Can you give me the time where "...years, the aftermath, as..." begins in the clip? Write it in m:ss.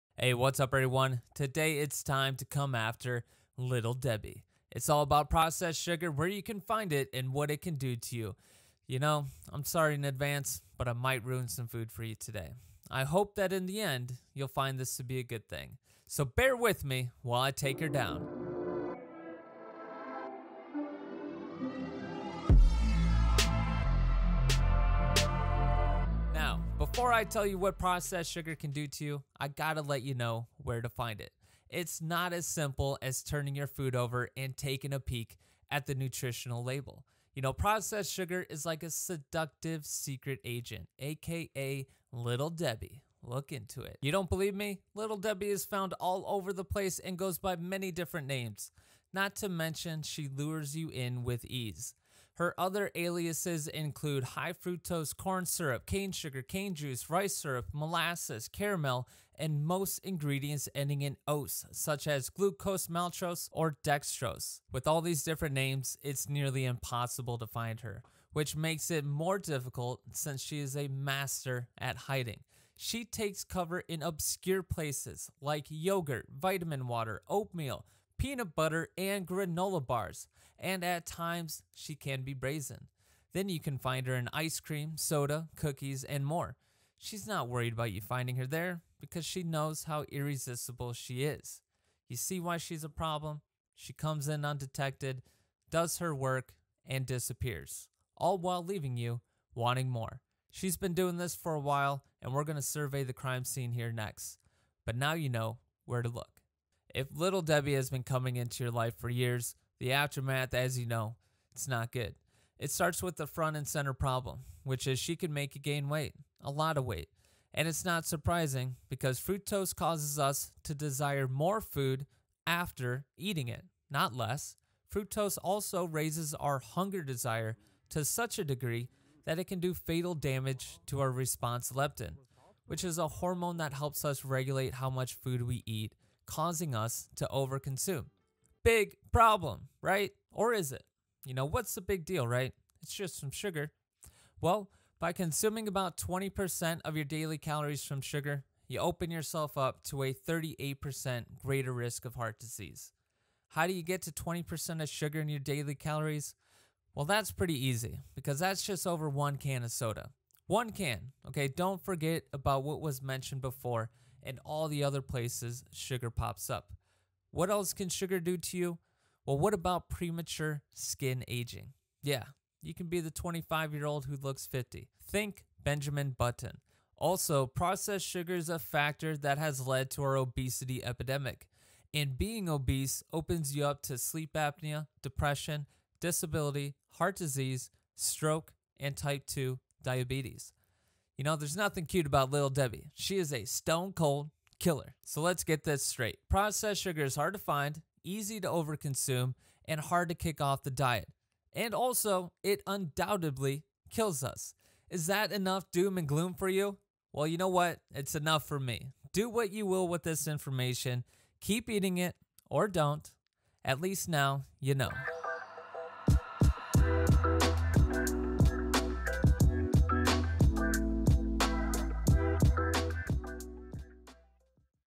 1:49.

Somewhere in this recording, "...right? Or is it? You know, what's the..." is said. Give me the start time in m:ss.
2:19.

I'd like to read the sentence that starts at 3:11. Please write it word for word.
You know, there's nothing cute about Little Debbie.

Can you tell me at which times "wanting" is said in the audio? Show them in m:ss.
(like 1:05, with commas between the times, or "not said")
1:39.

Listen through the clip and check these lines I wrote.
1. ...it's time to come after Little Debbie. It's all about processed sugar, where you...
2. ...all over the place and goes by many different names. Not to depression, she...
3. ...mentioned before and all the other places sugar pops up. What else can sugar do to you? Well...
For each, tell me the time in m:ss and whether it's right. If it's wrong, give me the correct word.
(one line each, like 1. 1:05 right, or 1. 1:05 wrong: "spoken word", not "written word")
1. 0:01 right
2. 0:45 wrong: "mention", not "depression"
3. 2:43 right.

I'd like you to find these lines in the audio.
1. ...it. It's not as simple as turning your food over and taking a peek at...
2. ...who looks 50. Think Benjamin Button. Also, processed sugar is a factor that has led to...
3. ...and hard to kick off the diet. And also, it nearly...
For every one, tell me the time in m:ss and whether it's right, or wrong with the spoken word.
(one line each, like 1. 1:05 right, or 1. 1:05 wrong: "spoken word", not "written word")
1. 0:31 right
2. 2:54 right
3. 3:19 wrong: "undoubtedly", not "nearly".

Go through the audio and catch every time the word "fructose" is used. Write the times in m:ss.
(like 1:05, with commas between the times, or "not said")
0:54, 1:59, 2:04.